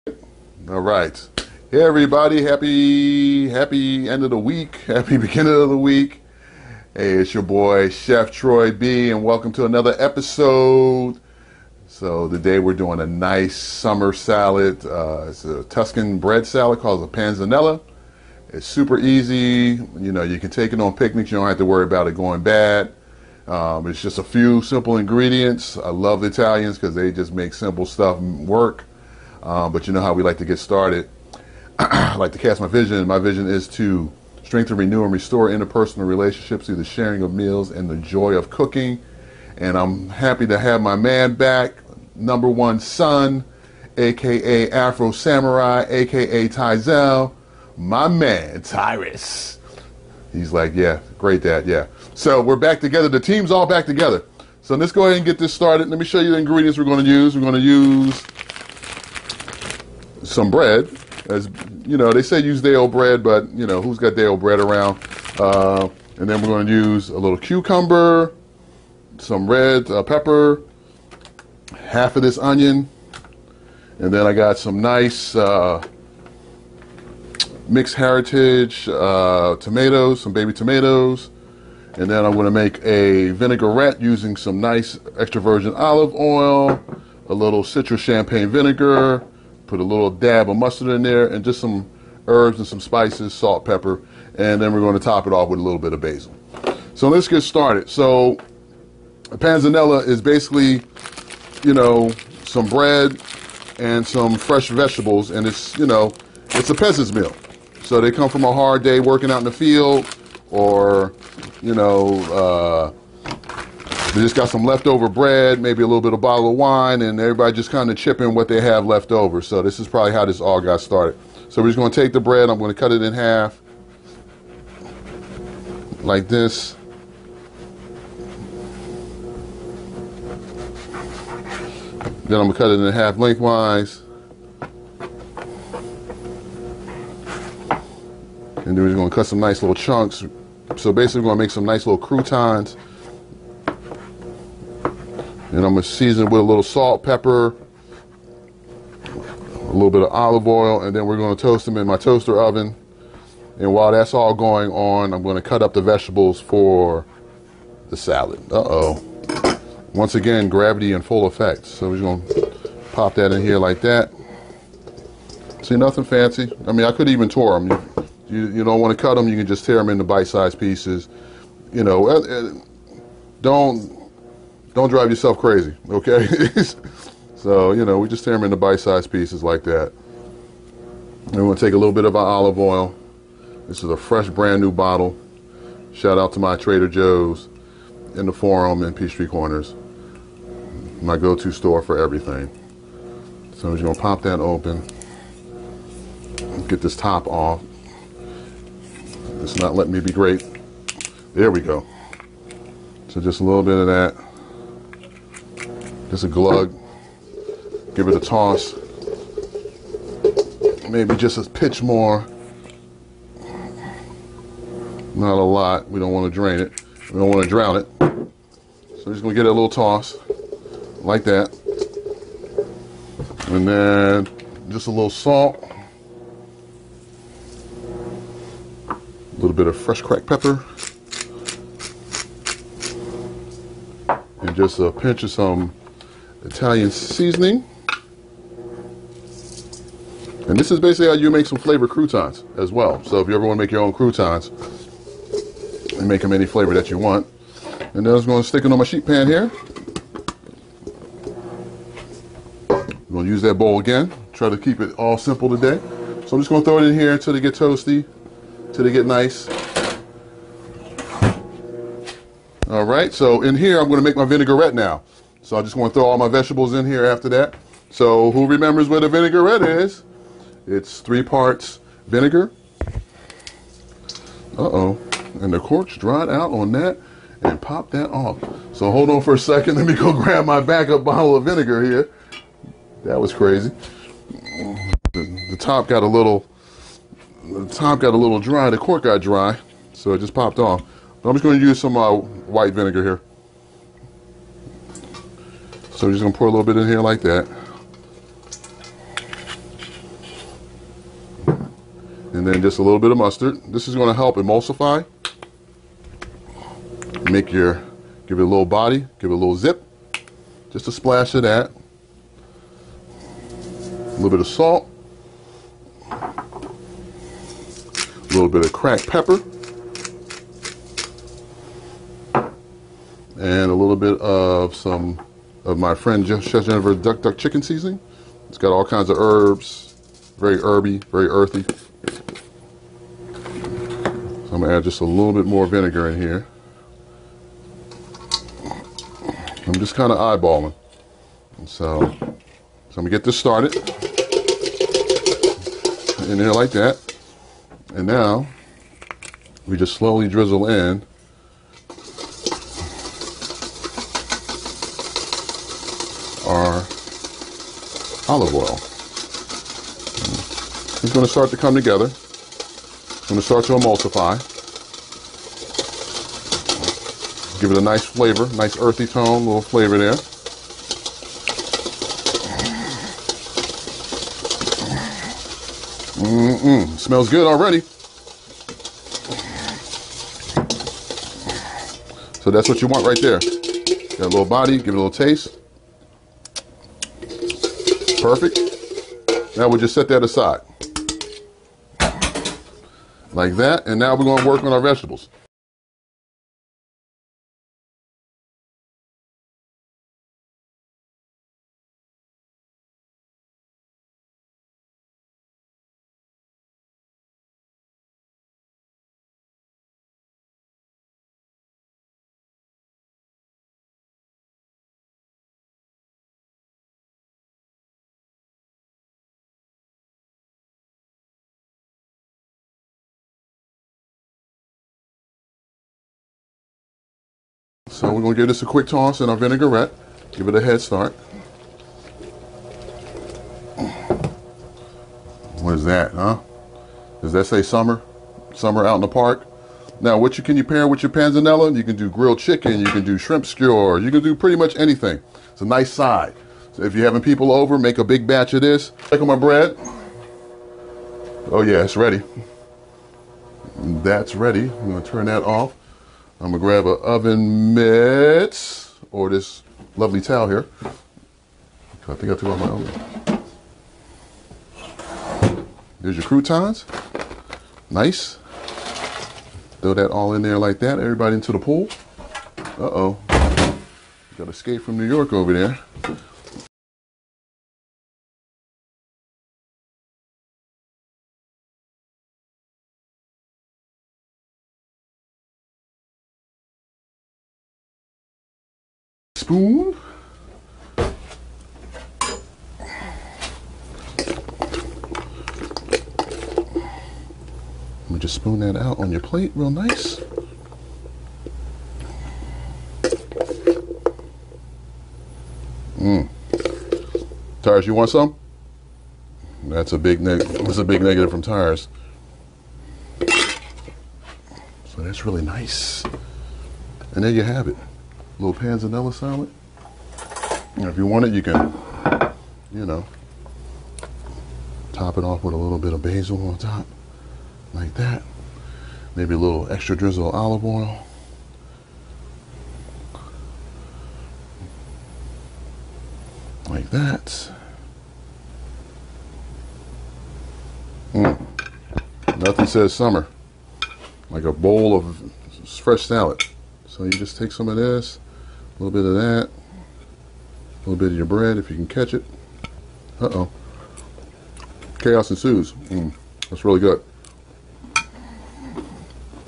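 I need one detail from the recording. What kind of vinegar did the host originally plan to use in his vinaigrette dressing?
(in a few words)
Citrus champagne vinegar.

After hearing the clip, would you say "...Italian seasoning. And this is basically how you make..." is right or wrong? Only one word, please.
right.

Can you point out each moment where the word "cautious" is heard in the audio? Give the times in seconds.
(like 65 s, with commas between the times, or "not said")
not said.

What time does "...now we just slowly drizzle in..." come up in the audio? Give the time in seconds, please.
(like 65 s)
348 s.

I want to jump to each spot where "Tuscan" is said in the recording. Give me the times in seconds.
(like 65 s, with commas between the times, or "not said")
15 s.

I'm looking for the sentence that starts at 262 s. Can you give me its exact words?
All right, so in here I'm going to make my vinaigrette now.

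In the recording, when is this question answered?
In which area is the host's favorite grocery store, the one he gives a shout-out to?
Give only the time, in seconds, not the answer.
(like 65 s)
188 s.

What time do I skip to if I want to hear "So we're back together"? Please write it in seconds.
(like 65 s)
52 s.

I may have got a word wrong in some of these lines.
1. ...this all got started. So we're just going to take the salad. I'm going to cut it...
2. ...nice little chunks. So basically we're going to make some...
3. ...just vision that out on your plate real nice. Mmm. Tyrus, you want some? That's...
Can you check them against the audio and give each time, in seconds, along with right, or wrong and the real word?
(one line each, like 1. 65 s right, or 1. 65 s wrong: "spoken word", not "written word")
1. 120 s wrong: "bread", not "salad"
2. 139 s right
3. 498 s wrong: "spoon", not "vision".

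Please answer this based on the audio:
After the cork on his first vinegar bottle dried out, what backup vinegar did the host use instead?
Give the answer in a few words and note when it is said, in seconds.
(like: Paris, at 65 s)
White vinegar, at 292 s.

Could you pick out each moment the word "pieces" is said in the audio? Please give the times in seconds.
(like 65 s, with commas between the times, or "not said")
170 s, 179 s.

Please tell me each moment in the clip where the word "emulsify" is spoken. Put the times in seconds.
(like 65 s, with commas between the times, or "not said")
304 s, 363 s.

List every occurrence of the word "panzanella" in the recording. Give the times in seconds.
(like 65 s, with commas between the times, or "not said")
17 s, 99 s, 441 s, 518 s.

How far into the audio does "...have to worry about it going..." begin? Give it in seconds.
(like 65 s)
21 s.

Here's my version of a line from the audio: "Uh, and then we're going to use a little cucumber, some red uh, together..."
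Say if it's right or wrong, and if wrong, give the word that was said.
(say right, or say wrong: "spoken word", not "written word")
wrong: "pepper", not "together".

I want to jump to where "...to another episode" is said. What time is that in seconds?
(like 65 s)
9 s.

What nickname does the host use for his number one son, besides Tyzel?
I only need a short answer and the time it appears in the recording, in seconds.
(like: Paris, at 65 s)
Afro Samurai, at 44 s.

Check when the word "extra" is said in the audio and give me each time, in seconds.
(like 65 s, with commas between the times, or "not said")
85 s, 529 s.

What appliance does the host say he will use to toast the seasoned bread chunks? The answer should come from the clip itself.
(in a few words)
Toaster oven.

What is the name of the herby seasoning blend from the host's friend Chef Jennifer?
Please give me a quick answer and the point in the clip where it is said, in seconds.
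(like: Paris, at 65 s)
Duck Duck Chicken Seasoning, at 326 s.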